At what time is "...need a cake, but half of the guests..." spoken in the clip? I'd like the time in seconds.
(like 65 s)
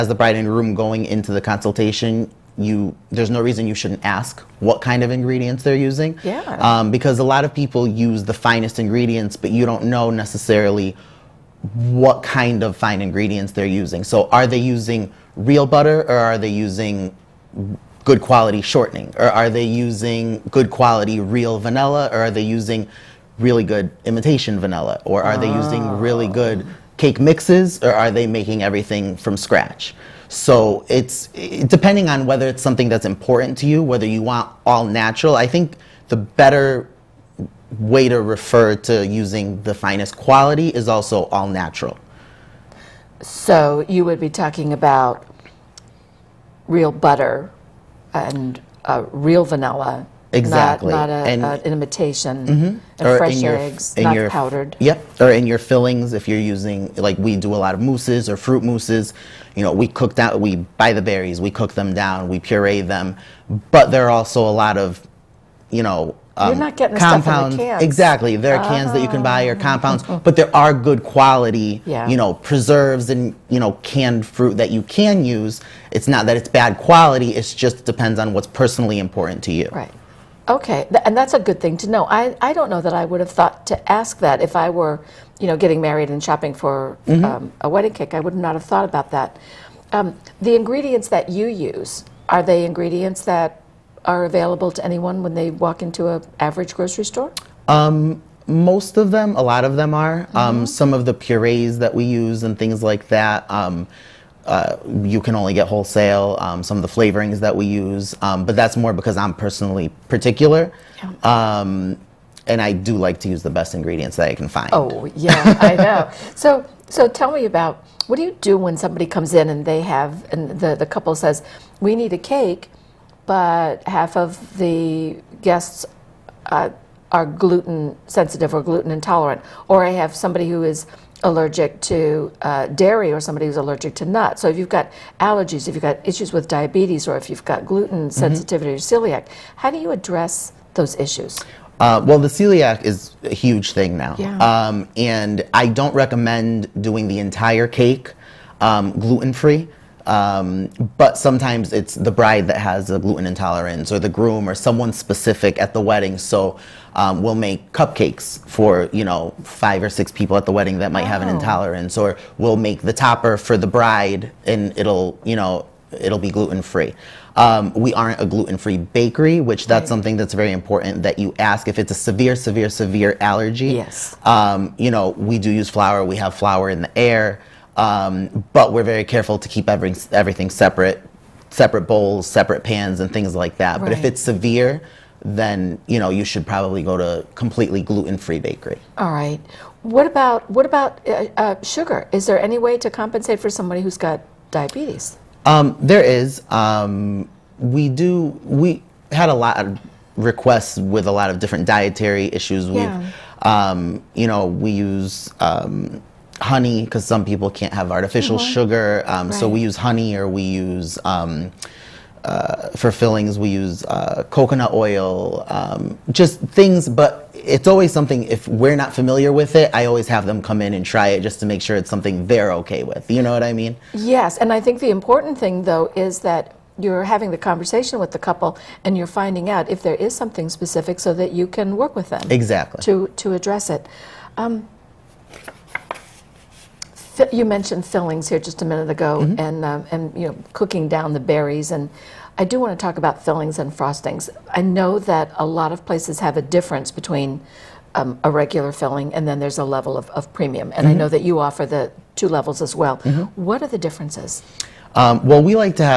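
121 s.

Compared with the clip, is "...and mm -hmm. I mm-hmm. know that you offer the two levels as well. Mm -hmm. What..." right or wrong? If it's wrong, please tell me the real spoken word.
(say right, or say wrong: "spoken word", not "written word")
right.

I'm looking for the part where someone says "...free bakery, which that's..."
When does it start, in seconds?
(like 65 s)
168 s.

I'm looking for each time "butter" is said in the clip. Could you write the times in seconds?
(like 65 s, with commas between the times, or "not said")
15 s, 46 s.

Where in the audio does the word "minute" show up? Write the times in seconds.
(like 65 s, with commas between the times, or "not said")
238 s.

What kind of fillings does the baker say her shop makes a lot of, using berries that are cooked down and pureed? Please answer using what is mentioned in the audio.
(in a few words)
fruit mousses.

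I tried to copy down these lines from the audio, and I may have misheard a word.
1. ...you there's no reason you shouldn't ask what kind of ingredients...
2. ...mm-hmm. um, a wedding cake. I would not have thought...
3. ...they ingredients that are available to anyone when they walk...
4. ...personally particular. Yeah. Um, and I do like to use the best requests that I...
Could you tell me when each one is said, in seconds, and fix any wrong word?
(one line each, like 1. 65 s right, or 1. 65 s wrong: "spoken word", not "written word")
1. 2 s right
2. 87 s right
3. 92 s right
4. 109 s wrong: "ingredients", not "requests".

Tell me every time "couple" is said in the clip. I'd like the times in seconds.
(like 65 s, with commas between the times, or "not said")
120 s, 228 s.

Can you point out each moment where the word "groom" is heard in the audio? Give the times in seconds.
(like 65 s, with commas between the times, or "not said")
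0 s, 154 s.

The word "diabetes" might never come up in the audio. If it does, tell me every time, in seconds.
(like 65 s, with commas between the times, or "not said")
136 s, 194 s.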